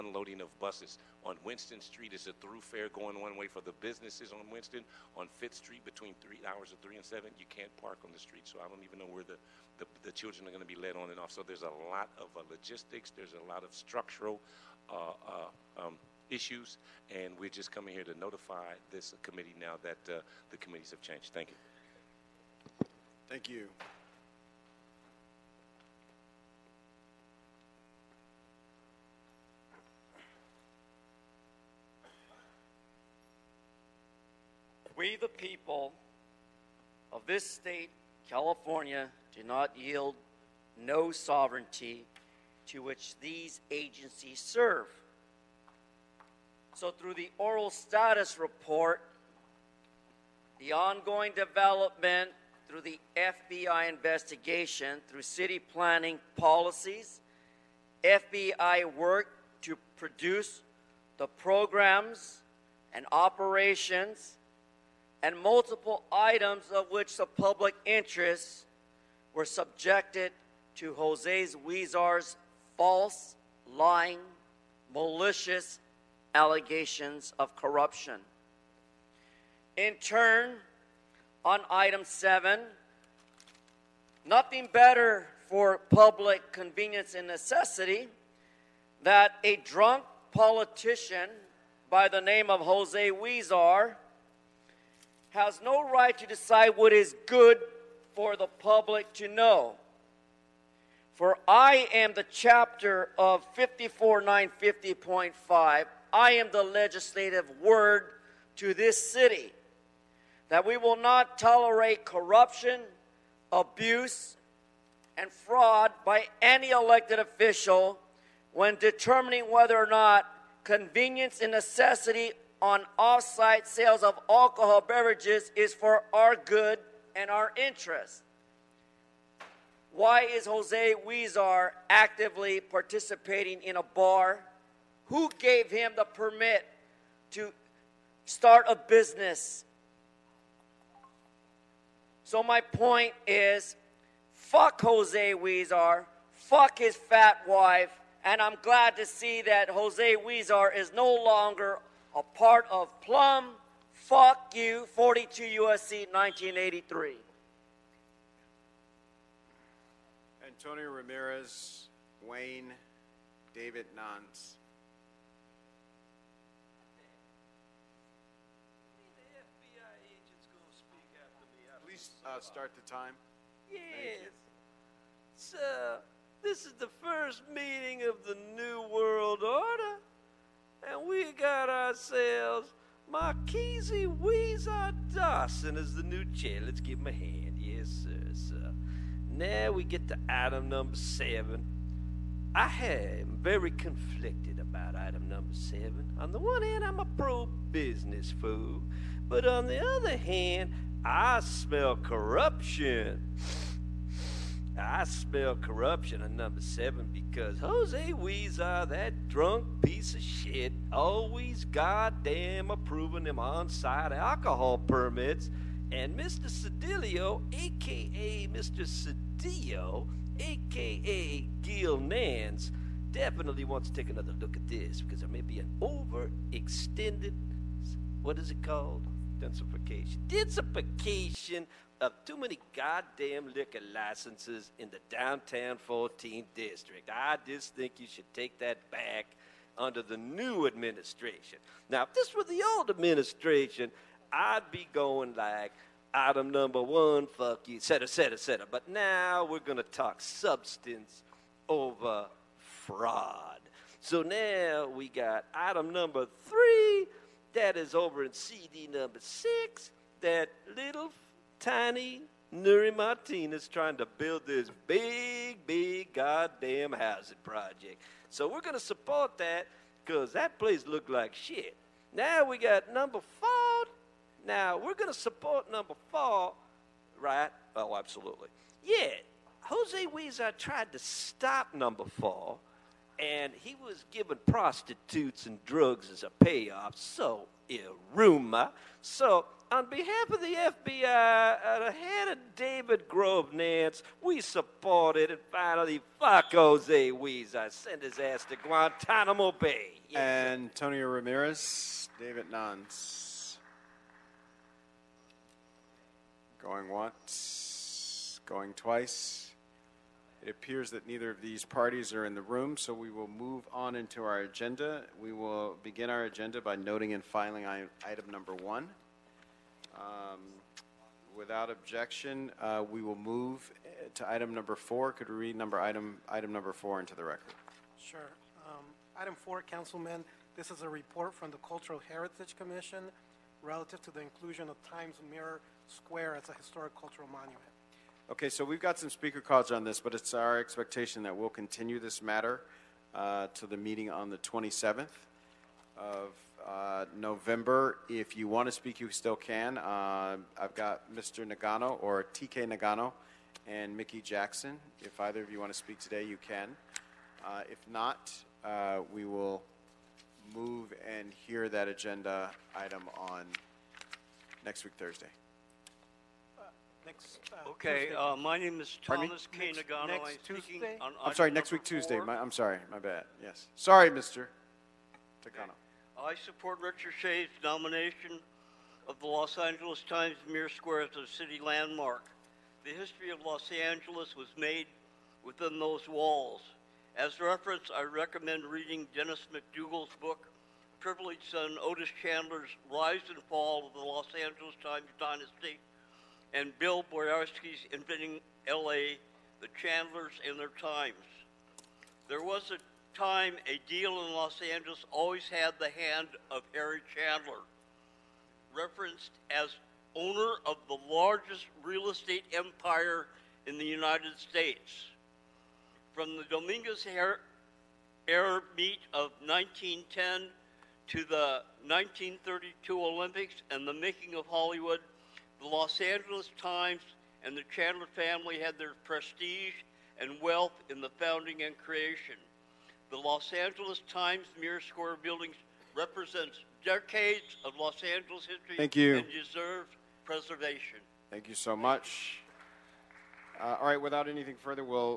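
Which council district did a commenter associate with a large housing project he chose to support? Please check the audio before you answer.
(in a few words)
CD 6.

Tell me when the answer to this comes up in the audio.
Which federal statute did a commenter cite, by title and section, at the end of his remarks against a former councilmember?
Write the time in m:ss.
2:34.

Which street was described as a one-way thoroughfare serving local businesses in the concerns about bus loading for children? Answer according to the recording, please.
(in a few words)
Winston Street.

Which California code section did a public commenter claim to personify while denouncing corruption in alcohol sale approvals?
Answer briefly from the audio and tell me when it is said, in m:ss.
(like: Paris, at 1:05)
54950.5, at 1:43.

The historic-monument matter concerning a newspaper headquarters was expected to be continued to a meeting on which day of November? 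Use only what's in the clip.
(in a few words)
27th.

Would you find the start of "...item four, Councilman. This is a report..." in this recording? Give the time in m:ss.
5:29.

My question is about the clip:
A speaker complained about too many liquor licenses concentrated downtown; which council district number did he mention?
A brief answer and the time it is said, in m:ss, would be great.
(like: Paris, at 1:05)
14th, at 3:55.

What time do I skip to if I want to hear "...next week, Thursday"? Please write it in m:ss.
6:04.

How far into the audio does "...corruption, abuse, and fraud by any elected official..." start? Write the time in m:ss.
1:52.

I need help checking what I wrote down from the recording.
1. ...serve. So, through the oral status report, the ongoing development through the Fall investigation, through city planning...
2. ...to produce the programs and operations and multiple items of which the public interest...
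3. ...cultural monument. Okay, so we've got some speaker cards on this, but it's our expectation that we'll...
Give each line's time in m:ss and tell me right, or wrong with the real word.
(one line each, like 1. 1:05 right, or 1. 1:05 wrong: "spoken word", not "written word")
1. 0:44 wrong: "FBI", not "Fall"
2. 0:59 right
3. 5:36 right.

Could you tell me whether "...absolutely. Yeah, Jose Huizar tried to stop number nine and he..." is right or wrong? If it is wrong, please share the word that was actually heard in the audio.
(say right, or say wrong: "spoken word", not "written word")
wrong: "four", not "nine".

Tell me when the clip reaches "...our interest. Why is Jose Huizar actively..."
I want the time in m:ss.
2:07.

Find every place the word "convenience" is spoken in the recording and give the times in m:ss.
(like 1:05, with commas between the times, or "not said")
1:26, 2:00.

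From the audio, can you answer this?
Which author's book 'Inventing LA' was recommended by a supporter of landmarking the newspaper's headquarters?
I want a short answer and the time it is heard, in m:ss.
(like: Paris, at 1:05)
Bill Boyarsky, at 6:36.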